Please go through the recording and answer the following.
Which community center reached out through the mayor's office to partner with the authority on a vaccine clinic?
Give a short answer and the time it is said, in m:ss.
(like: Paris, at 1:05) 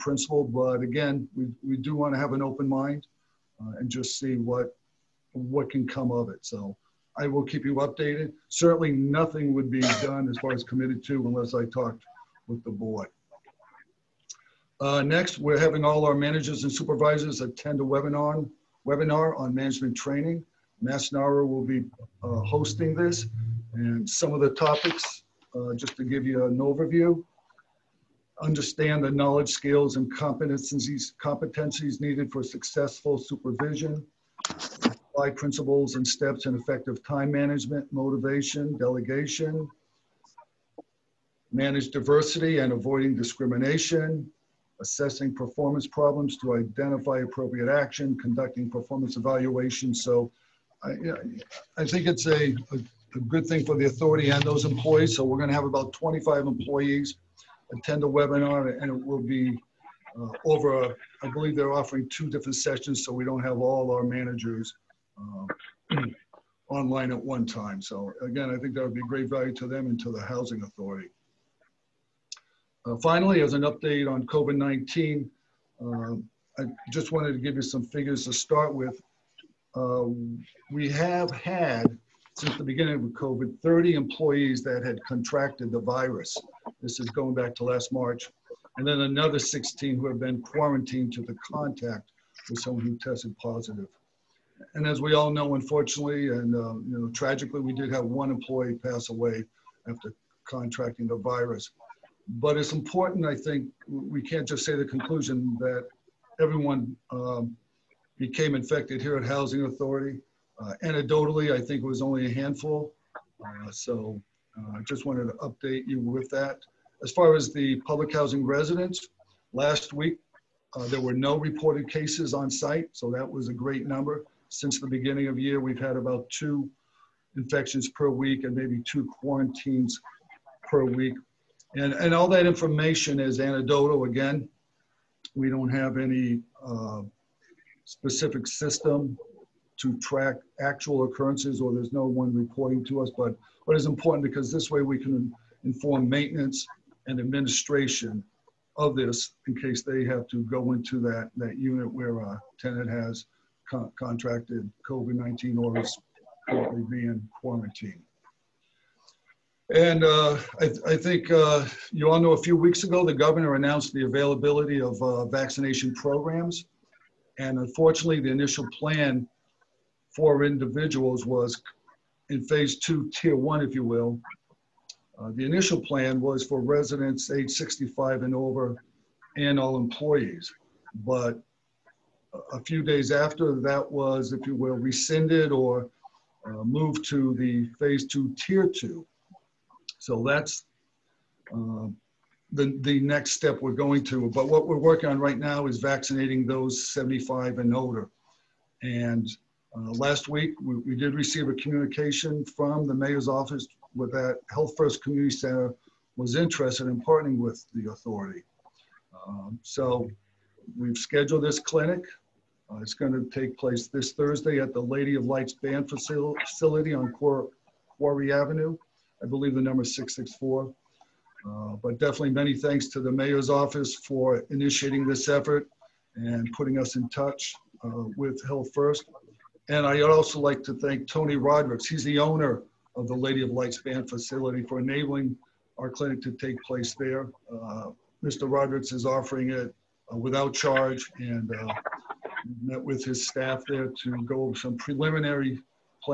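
Health First Community Center, at 3:24.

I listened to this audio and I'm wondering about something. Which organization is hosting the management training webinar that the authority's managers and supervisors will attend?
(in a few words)
MassNAHRO.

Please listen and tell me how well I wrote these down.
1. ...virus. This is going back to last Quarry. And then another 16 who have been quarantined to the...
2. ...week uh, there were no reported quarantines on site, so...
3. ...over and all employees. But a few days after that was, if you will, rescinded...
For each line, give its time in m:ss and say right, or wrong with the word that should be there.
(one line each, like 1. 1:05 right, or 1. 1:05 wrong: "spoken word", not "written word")
1. 1:25 wrong: "March", not "Quarry"
2. 1:59 wrong: "cases", not "quarantines"
3. 2:58 right.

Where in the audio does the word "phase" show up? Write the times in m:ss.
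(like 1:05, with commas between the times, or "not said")
2:52, 3:07.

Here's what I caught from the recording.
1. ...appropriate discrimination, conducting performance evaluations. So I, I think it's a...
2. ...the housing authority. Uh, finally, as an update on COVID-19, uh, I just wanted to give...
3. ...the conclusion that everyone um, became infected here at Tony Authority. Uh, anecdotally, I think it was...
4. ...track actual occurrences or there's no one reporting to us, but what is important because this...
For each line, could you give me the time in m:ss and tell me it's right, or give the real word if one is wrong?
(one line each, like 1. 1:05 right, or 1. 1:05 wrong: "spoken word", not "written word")
1. 0:47 wrong: "action", not "discrimination"
2. 1:10 right
3. 1:44 wrong: "Housing", not "Tony"
4. 2:19 right.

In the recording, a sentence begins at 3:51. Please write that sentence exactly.
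He's the owner of the Lady of Lights Band facility for enabling our clinic to take place there.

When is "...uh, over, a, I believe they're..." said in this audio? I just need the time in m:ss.
1:00.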